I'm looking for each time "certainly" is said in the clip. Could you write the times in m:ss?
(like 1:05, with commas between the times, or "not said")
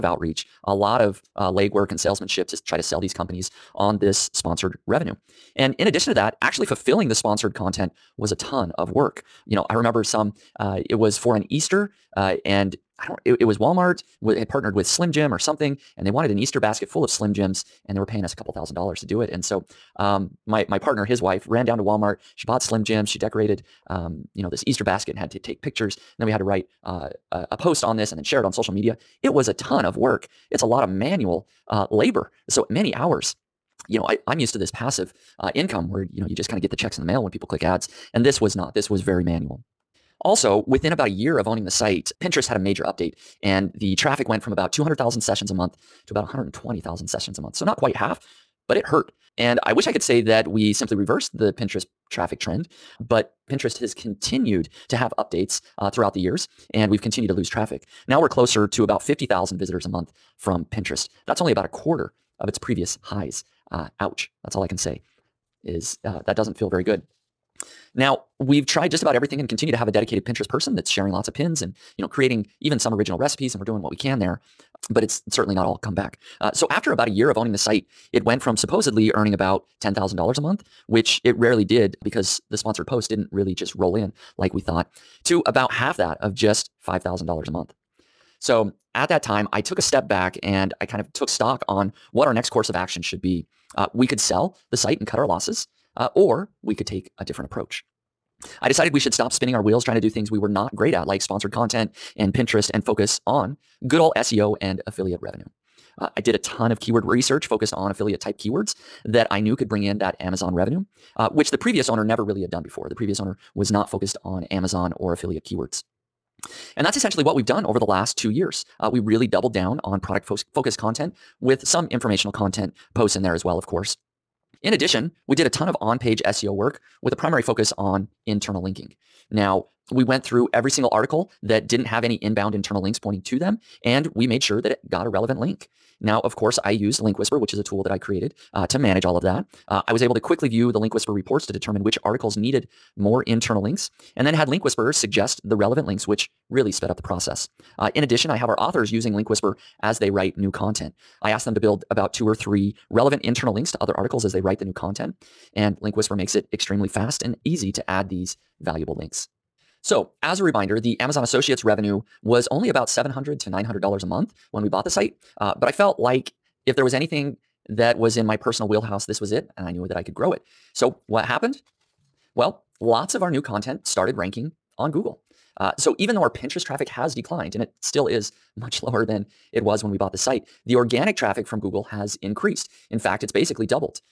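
1:15.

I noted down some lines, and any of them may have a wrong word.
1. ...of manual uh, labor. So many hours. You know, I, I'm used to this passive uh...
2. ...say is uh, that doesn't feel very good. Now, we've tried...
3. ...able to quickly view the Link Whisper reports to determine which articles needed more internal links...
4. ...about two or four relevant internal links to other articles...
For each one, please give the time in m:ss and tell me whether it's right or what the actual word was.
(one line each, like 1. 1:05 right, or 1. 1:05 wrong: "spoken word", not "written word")
1. 0:30 right
2. 1:04 right
3. 2:20 right
4. 2:31 wrong: "three", not "four".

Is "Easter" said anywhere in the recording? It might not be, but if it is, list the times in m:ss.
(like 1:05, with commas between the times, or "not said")
0:11, 0:16, 0:24.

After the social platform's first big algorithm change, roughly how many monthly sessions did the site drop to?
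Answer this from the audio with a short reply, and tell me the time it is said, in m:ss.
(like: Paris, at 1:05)
120,000, at 0:46.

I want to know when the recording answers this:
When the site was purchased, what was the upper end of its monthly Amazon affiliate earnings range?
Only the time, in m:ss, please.
2:43.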